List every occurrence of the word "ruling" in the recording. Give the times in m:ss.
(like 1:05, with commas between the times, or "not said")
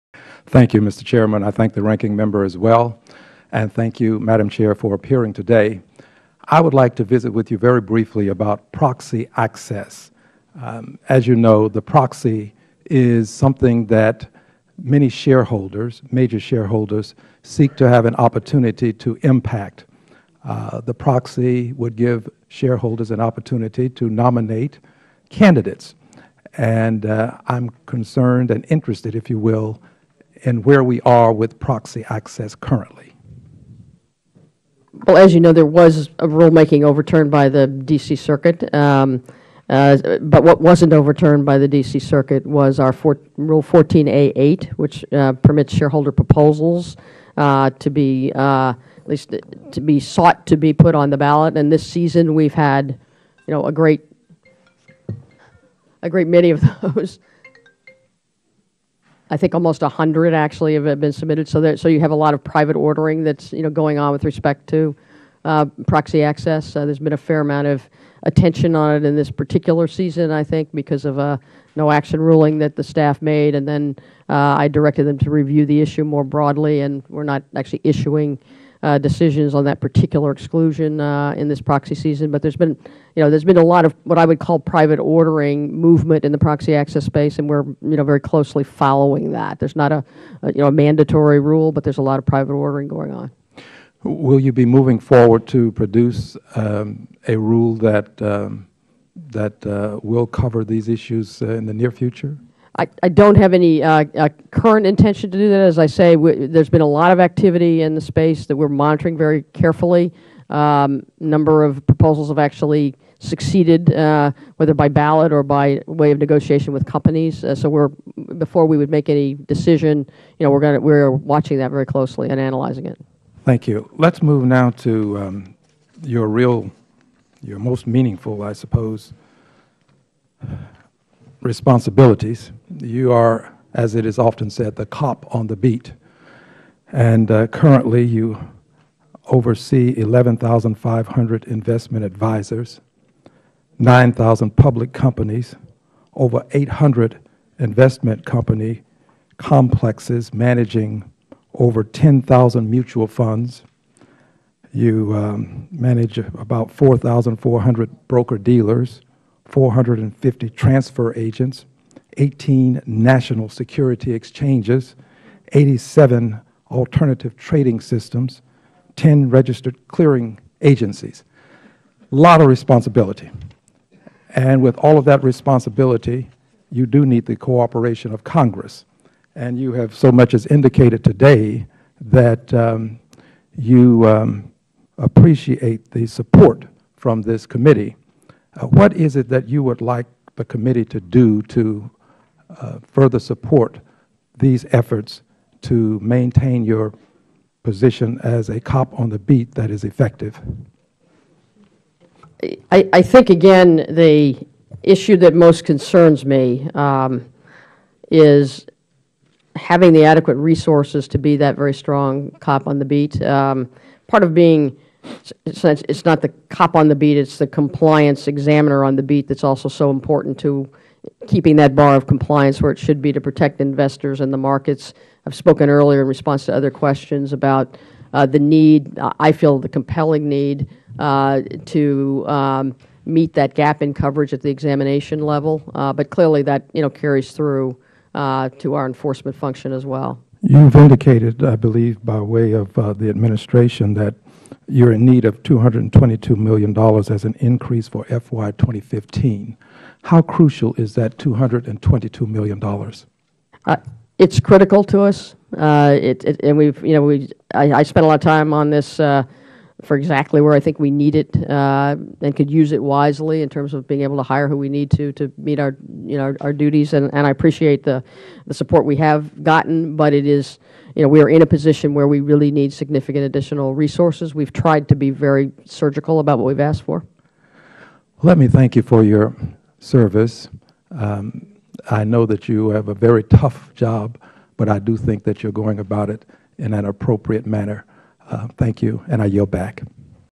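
1:12.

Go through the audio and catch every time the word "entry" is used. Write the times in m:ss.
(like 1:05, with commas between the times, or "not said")
not said.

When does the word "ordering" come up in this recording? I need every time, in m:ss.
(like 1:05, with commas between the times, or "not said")
1:02, 1:24, 1:32.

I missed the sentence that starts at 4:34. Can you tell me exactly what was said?
We've tried to be very surgical about what we've asked for.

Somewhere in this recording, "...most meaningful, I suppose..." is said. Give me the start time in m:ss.
2:07.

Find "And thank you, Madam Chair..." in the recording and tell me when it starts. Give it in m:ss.
0:03.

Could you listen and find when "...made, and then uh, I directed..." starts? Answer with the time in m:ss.
1:13.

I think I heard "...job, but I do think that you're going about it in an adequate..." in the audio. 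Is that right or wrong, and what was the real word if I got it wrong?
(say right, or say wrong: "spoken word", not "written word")
wrong: "appropriate", not "adequate".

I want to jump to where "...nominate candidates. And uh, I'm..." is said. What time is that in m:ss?
0:24.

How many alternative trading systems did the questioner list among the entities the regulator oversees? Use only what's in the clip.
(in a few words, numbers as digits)
87.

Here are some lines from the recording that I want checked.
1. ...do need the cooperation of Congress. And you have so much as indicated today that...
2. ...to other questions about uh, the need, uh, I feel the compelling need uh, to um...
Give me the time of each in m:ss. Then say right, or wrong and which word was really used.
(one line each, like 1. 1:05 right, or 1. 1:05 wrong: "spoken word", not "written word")
1. 2:56 right
2. 3:46 right.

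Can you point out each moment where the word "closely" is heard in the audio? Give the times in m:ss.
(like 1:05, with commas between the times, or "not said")
1:28, 2:01.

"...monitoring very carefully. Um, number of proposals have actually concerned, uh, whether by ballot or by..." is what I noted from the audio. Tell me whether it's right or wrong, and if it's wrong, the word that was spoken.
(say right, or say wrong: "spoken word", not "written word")
wrong: "succeeded", not "concerned".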